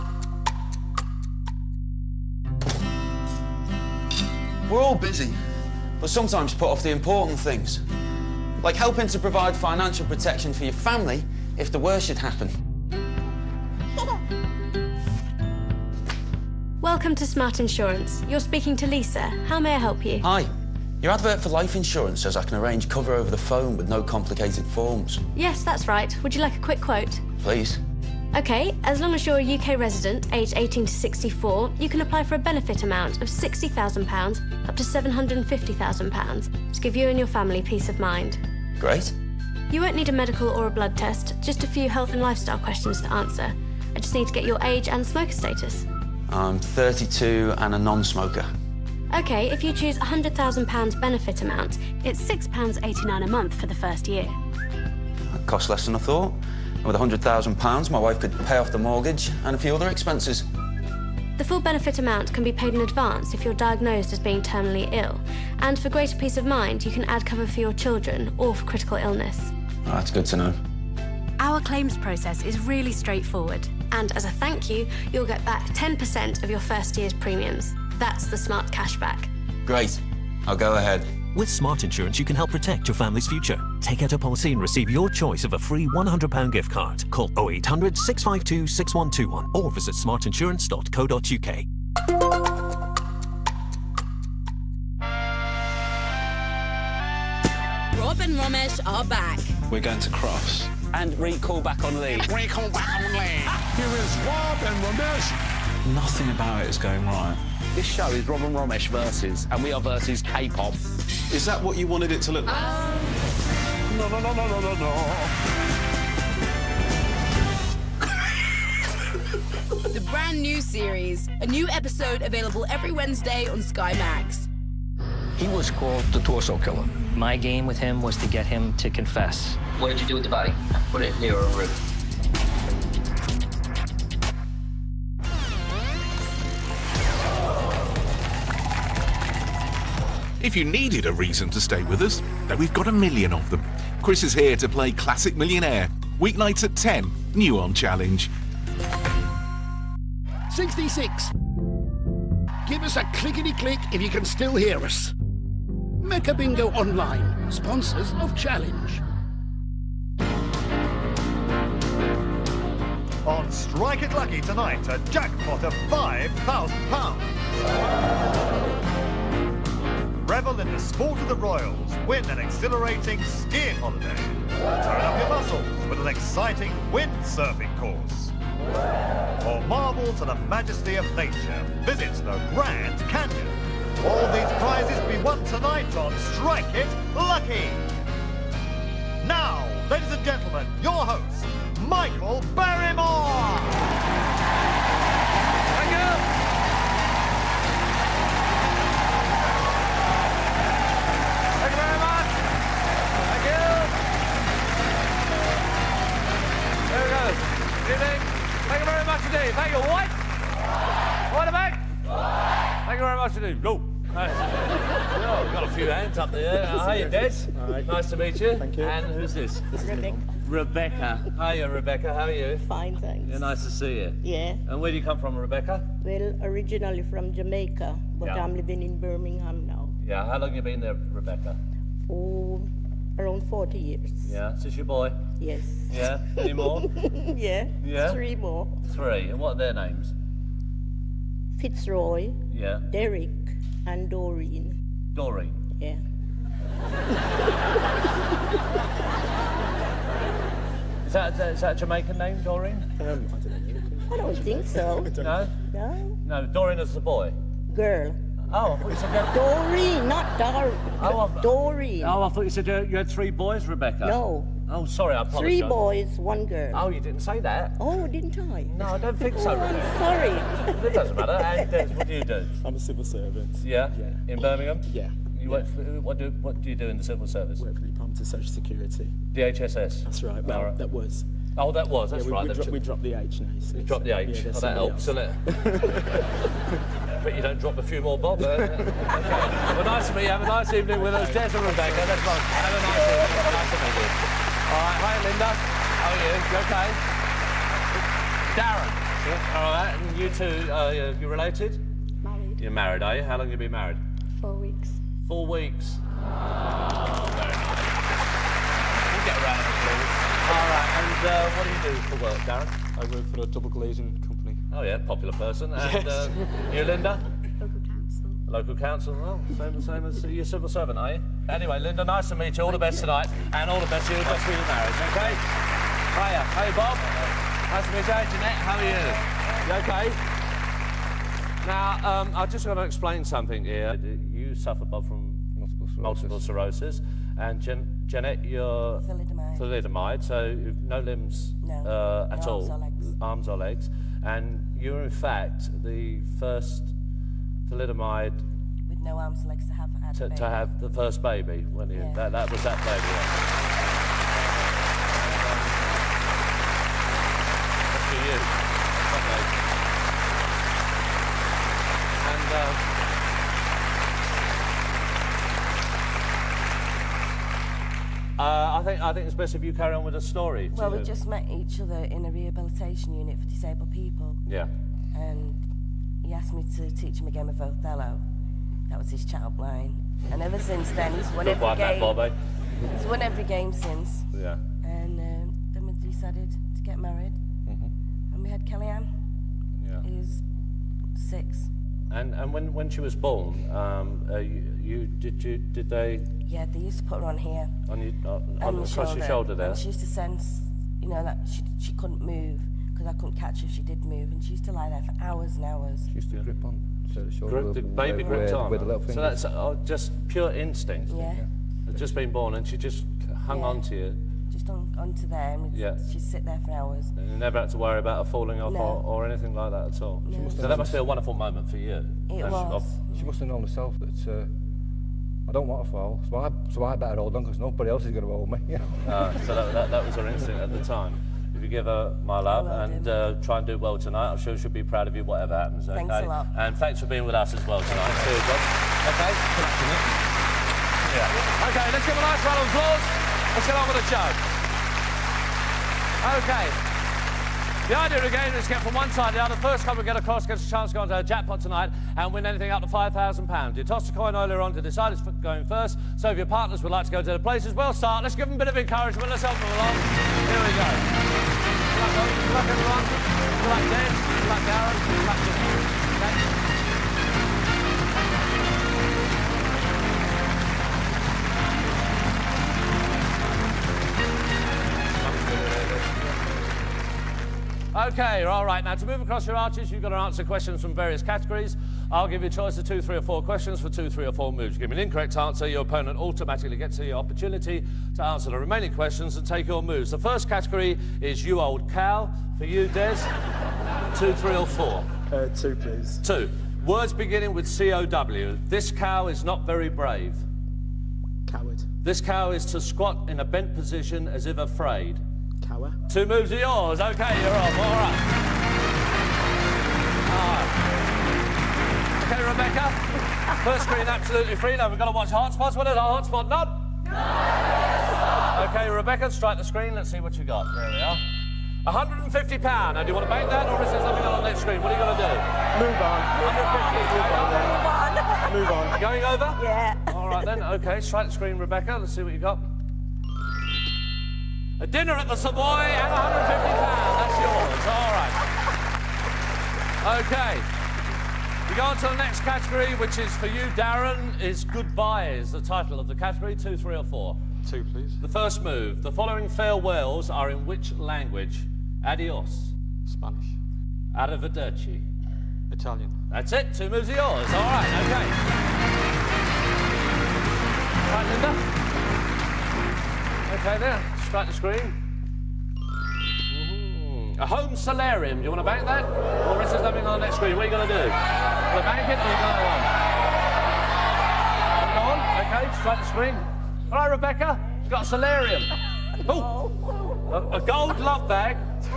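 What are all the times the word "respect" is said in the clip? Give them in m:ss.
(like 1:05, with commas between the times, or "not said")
not said.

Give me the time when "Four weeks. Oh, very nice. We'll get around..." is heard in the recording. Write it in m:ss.
5:05.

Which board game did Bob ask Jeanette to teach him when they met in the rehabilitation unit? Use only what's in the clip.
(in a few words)
Othello.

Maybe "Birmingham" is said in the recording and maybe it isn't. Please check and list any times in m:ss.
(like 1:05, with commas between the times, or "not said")
3:48, 4:34.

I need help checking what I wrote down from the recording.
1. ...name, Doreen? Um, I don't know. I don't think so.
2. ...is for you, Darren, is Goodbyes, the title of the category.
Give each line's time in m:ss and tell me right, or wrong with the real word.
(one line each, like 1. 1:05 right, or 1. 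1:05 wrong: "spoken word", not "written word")
1. 4:12 right
2. 9:03 right.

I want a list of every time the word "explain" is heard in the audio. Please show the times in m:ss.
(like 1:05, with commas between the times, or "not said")
5:32.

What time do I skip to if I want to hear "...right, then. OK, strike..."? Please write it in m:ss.
8:50.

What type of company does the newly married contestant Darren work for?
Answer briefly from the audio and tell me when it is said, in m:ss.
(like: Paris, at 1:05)
double glazing, at 5:13.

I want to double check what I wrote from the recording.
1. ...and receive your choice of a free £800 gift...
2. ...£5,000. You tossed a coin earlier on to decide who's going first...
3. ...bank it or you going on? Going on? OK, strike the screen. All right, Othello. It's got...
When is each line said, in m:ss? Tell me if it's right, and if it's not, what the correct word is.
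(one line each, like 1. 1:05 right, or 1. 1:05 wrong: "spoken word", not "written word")
1. 1:24 wrong: "100", not "800"
2. 7:32 right
3. 9:31 wrong: "Rebecca", not "Othello".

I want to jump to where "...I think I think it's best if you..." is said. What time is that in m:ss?
6:08.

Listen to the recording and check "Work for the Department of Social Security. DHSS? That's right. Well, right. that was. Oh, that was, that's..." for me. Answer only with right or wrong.
right.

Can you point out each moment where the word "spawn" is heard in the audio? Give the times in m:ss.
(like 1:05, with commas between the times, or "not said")
not said.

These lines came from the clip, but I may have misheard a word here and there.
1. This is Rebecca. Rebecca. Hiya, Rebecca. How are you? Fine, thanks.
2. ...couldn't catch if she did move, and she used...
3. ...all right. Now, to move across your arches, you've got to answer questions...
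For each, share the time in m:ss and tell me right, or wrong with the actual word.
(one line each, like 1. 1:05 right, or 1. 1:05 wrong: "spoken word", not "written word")
1. 3:39 right
2. 6:43 right
3. 7:58 right.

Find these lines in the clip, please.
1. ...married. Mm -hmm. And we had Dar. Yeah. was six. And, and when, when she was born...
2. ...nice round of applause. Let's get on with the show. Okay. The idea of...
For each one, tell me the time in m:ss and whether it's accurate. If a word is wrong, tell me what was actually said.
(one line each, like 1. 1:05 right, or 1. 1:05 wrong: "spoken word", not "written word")
1. 6:26 wrong: "Kellyanne", not "Dar"
2. 7:22 right.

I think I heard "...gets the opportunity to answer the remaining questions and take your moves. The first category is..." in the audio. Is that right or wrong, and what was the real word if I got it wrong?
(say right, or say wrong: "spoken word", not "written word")
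right.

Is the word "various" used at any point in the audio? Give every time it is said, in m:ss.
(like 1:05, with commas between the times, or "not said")
8:00.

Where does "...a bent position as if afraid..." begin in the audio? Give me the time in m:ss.
8:23.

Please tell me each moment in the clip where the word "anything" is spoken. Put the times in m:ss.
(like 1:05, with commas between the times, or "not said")
6:59, 7:32.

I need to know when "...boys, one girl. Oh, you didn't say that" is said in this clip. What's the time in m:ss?
4:25.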